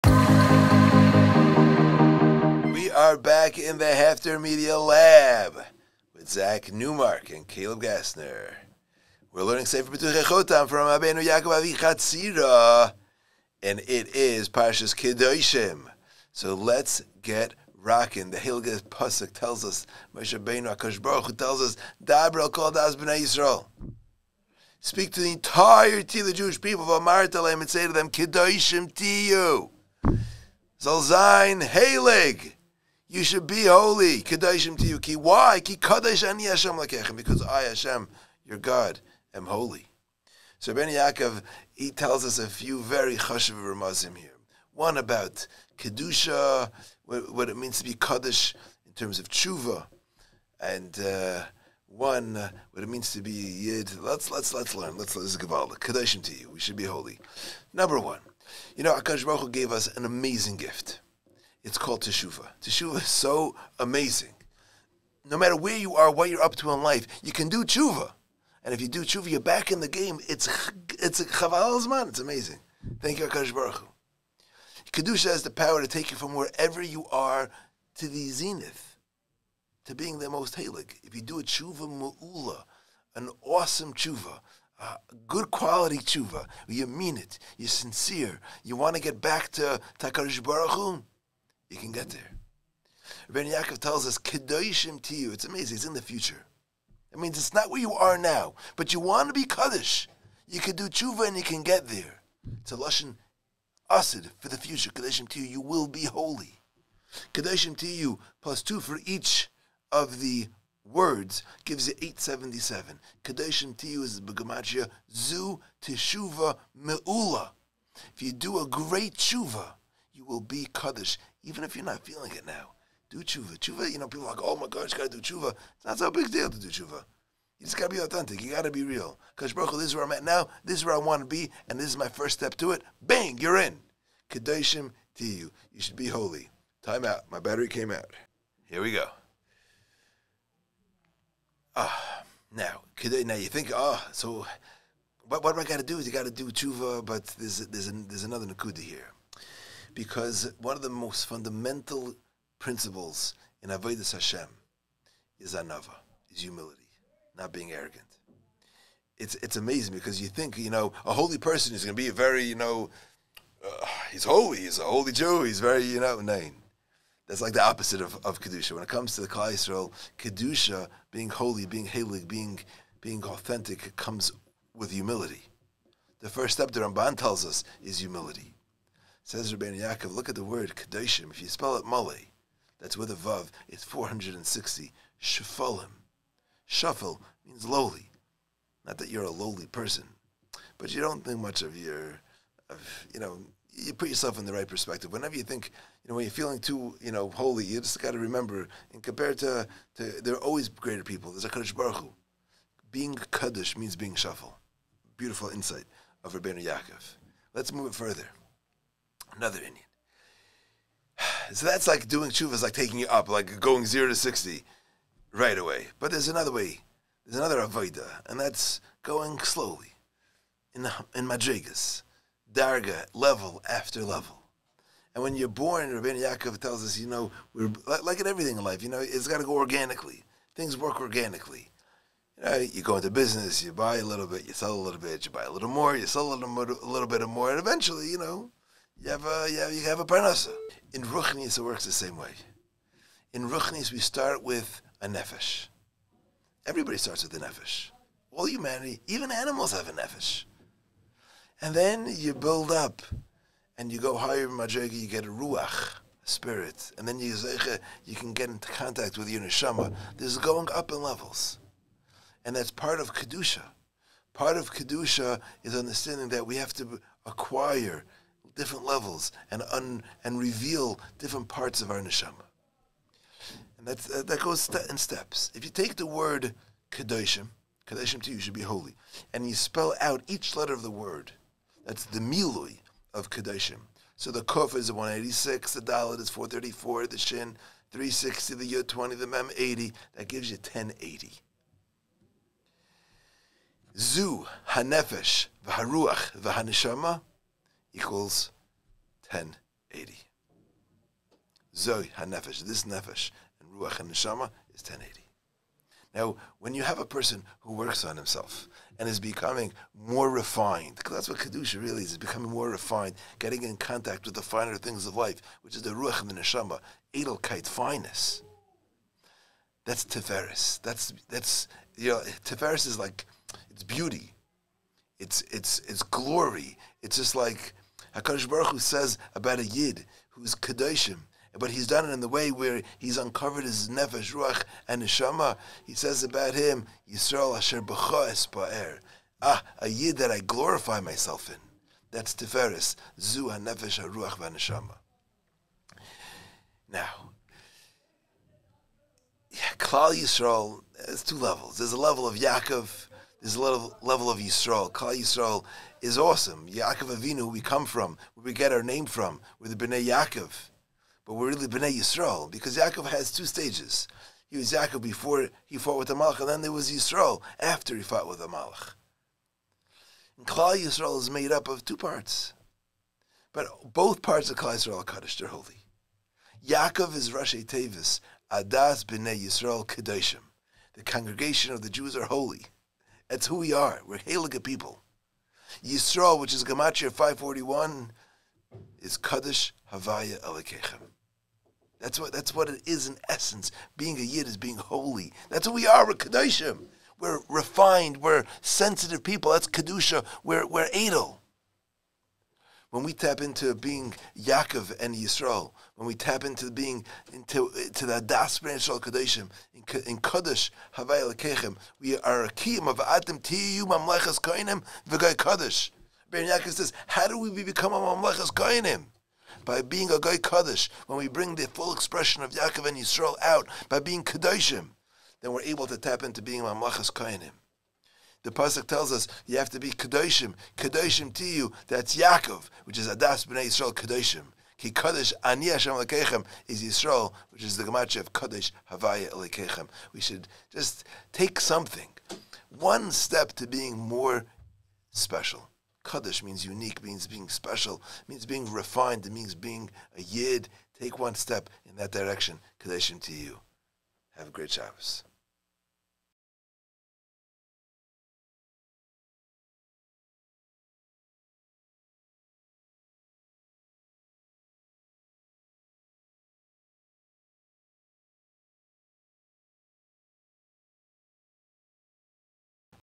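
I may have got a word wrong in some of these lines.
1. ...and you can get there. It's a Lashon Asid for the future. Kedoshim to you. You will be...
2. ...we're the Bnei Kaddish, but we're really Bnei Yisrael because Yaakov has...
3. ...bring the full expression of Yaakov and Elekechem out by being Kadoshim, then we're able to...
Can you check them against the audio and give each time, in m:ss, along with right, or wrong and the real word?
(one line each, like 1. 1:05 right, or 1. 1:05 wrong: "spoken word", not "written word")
1. 1:41 right
2. 5:59 wrong: "Yaakov", not "Kaddish"
3. 7:01 wrong: "Yisrael", not "Elekechem".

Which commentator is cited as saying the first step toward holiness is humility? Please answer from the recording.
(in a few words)
Ramban.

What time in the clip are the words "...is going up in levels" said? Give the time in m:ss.
4:20.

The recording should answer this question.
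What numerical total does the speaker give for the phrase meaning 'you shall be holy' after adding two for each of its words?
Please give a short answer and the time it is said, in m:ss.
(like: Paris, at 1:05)
877, at 1:52.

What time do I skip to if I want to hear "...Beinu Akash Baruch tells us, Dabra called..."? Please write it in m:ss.
0:20.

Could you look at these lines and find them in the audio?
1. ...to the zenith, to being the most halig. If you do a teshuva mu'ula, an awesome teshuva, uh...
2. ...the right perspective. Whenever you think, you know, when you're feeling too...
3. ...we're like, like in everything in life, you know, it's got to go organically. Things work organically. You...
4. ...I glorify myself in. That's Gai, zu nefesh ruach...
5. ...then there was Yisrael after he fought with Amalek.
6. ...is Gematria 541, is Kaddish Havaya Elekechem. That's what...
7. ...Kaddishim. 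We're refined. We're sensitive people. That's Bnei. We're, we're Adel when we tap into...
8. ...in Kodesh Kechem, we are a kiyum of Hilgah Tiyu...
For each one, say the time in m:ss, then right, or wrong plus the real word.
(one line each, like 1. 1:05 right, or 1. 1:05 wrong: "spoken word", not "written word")
1. 1:17 right
2. 3:14 right
3. 3:47 right
4. 5:40 wrong: "Tiferes", not "Gai"
5. 6:06 right
6. 6:26 right
7. 6:36 wrong: "Kedusha", not "Bnei"
8. 6:50 wrong: "Adam", not "Hilgah".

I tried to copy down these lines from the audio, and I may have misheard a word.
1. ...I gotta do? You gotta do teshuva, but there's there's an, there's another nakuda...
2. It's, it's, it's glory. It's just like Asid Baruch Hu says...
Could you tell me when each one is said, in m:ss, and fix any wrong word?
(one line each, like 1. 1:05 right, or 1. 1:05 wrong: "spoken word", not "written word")
1. 2:25 wrong: "tshuva", not "teshuva"
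2. 5:25 wrong: "Hakadosh", not "Asid".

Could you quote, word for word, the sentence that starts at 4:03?
In Ruchnis, we start with a nefesh.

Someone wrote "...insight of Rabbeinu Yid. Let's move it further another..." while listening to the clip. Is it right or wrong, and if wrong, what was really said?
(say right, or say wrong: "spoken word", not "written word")
wrong: "Yaakov", not "Yid".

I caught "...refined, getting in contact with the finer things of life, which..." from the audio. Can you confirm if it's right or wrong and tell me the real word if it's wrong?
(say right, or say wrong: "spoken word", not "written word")
right.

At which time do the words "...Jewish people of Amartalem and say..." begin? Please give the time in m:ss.
0:26.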